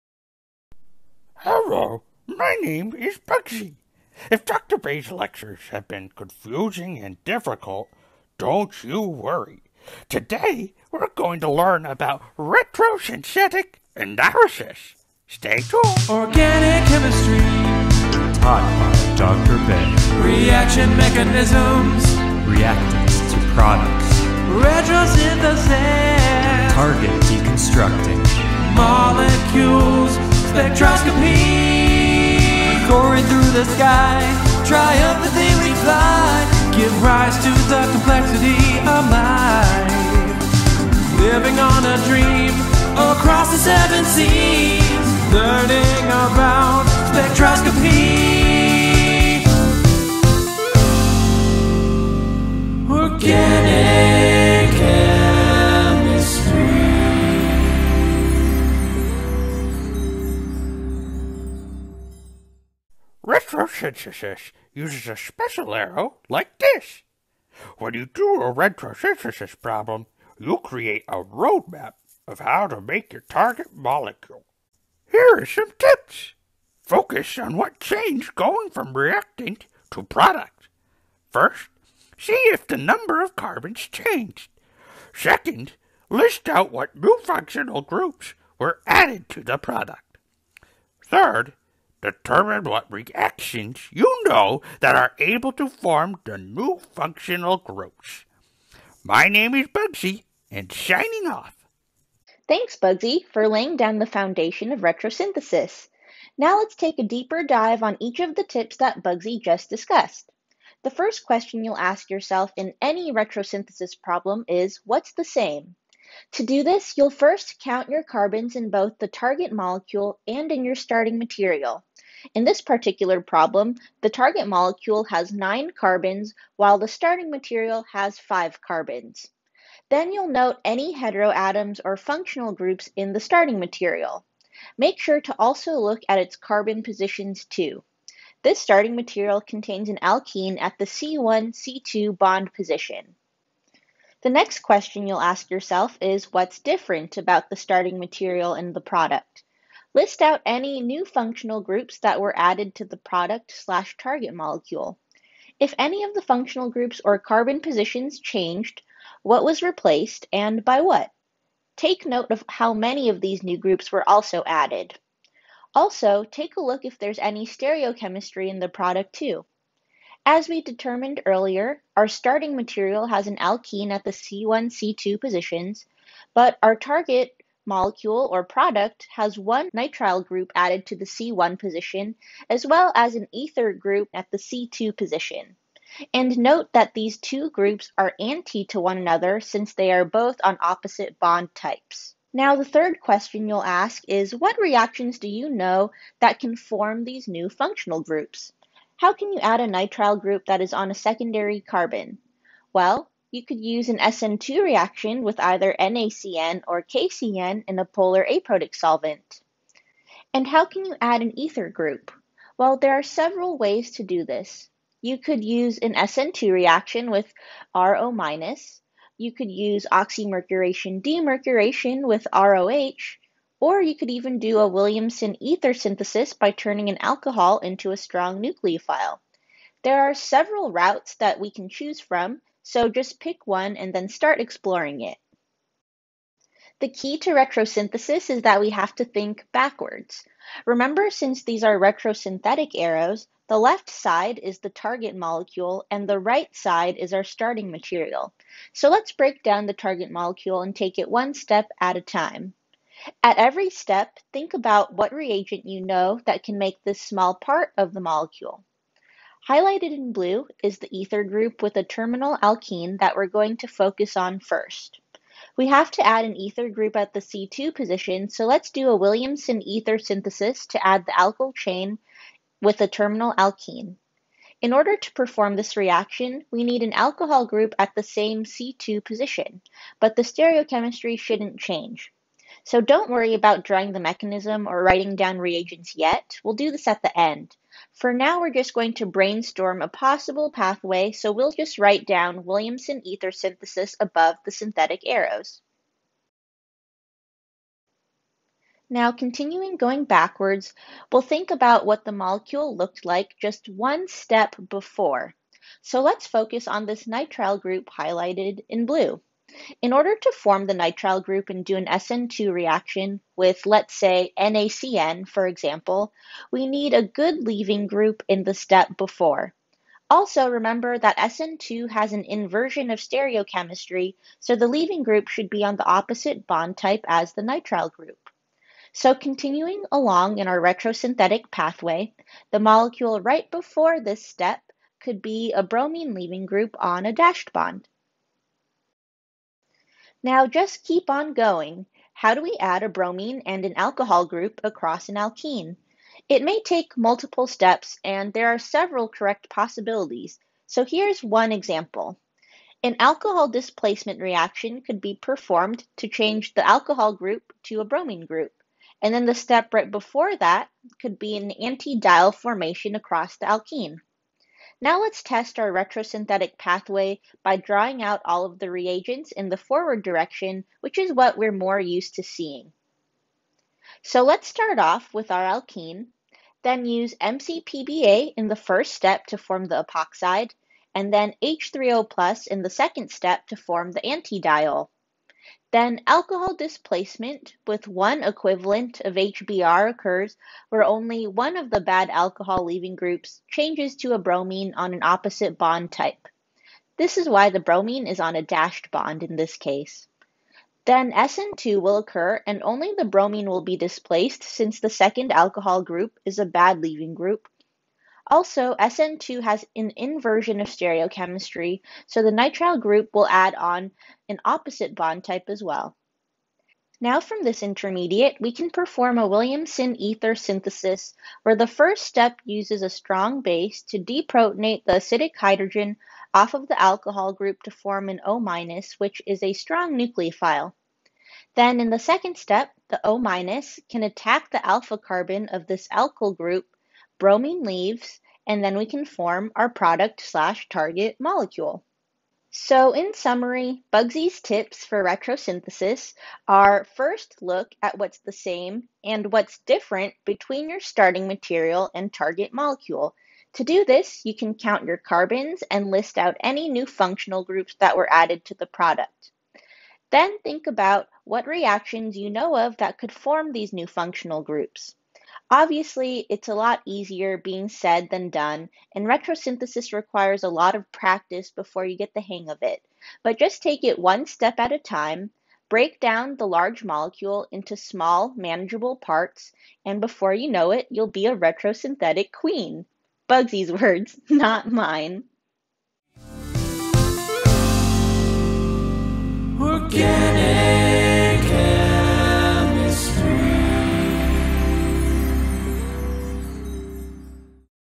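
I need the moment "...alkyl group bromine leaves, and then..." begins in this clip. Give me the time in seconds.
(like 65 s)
435 s.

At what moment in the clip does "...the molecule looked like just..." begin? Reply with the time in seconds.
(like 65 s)
302 s.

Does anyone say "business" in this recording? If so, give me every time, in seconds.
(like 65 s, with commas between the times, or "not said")
not said.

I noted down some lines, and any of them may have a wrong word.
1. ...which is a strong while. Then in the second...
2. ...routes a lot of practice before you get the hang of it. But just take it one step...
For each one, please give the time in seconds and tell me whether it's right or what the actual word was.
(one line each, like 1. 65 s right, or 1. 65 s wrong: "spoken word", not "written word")
1. 428 s wrong: "nucleophile", not "while"
2. 469 s wrong: "requires", not "routes".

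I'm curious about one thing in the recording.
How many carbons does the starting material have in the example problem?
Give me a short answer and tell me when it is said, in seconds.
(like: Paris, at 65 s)
5, at 128 s.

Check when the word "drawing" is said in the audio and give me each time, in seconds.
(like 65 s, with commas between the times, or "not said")
283 s, 367 s.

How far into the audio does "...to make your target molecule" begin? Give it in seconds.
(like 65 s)
72 s.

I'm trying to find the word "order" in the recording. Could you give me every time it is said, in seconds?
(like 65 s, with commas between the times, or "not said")
274 s, 309 s.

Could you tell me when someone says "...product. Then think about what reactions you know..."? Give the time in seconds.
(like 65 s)
458 s.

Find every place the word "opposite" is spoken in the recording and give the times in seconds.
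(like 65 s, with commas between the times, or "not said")
190 s, 325 s, 395 s, 414 s.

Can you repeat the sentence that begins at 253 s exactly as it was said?
At every step, think about what reagent you know that can make this small part of the molecule.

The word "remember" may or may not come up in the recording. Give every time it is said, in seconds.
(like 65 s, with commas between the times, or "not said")
240 s, 320 s.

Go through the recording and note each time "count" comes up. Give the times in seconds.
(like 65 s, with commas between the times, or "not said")
117 s, 454 s.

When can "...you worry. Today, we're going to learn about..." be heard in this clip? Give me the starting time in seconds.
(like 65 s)
8 s.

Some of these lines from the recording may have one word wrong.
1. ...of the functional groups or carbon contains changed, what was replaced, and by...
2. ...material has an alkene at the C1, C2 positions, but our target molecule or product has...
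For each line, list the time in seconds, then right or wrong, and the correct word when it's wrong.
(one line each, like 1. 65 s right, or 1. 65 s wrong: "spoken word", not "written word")
1. 156 s wrong: "positions", not "contains"
2. 172 s right.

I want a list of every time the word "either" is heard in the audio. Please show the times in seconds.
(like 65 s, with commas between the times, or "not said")
205 s.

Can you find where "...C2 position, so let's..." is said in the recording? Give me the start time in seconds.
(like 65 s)
267 s.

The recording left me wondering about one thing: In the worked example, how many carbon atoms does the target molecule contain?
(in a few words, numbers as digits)
9.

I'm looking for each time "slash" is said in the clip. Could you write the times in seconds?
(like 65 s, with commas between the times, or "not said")
153 s, 440 s.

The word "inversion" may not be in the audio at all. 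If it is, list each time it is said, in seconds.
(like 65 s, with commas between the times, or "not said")
322 s, 409 s.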